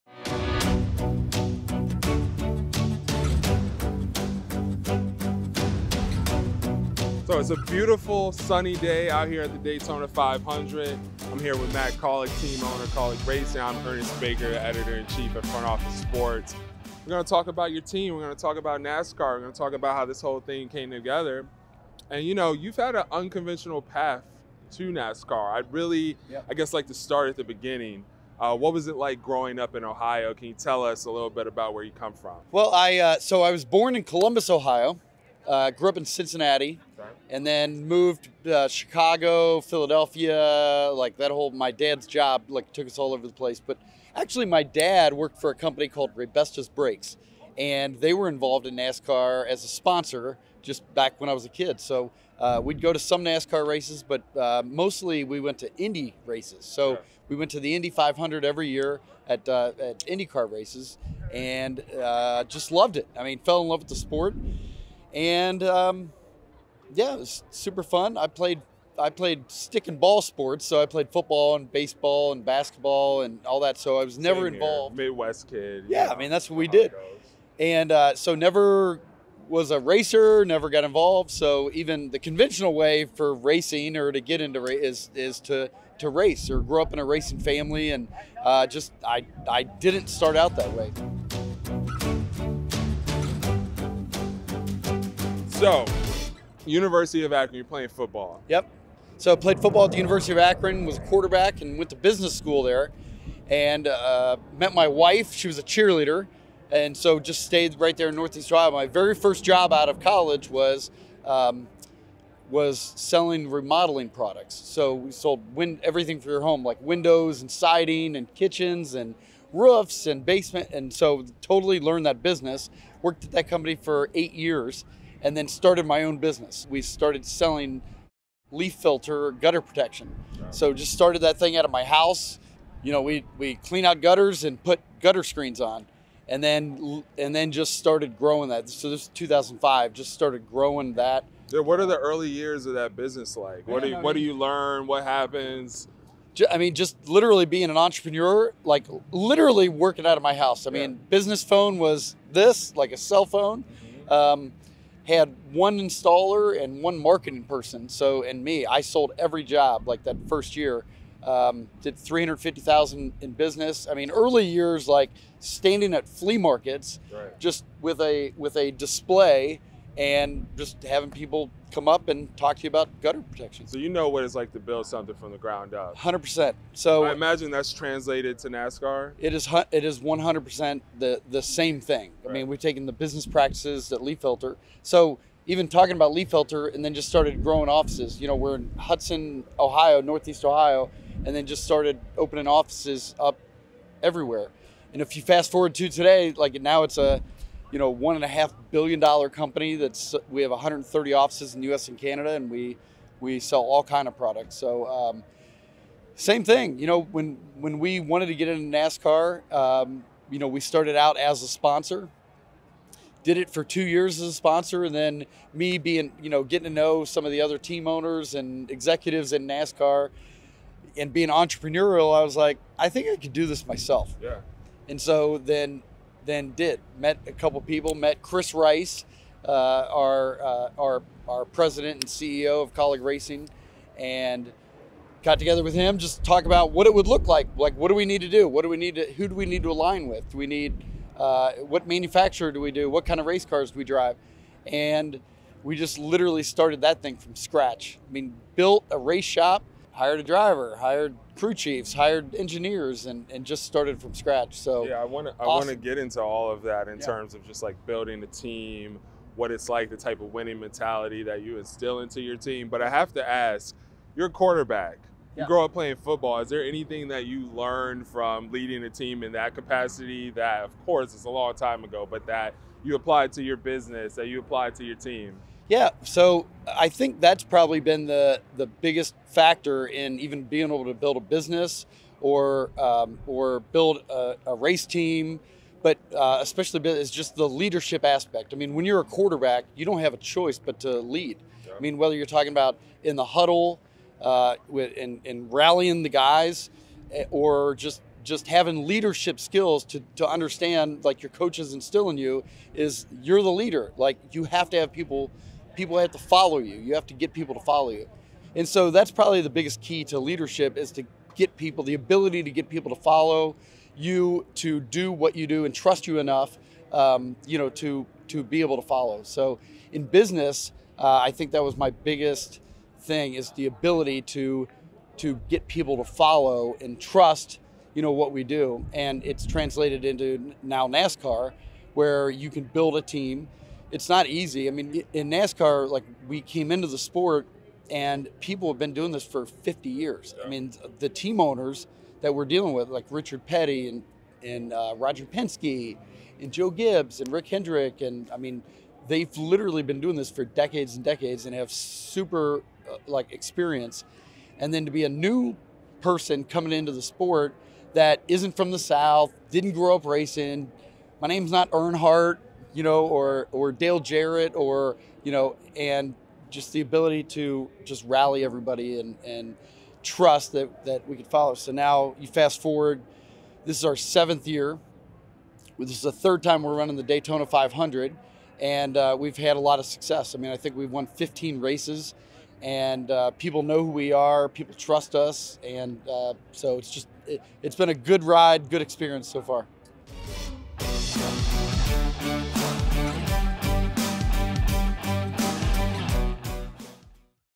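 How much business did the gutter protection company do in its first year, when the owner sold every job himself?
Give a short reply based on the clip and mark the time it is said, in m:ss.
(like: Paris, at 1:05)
350,000, at 2:41.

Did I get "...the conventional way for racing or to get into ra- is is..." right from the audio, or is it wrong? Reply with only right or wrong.
right.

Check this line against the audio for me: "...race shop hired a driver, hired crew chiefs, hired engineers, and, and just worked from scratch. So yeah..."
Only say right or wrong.
wrong.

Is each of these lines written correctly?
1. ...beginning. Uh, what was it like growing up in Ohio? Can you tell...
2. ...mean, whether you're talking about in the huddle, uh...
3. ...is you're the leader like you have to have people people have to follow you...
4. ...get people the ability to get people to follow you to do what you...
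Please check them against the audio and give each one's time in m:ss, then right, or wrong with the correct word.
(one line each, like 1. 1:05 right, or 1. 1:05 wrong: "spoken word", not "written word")
1. 0:27 right
2. 4:51 right
3. 5:02 right
4. 5:11 right.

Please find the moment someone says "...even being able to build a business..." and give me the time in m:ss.
4:40.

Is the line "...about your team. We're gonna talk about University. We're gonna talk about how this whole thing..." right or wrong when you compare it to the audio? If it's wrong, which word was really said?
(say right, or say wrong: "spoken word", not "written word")
wrong: "NASCAR", not "University".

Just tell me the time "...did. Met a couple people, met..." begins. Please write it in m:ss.
3:46.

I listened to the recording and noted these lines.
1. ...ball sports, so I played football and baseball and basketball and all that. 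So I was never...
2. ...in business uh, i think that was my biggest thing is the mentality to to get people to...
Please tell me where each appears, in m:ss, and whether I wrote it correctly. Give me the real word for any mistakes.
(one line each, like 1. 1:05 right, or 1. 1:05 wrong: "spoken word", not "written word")
1. 1:09 right
2. 5:19 wrong: "ability", not "mentality".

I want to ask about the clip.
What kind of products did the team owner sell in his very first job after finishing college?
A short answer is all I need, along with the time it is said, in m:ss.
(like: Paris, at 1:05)
Remodeling products, at 1:53.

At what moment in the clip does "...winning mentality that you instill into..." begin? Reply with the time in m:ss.
4:20.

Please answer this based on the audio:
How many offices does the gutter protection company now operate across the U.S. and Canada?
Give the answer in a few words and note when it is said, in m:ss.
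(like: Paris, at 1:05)
130, at 3:20.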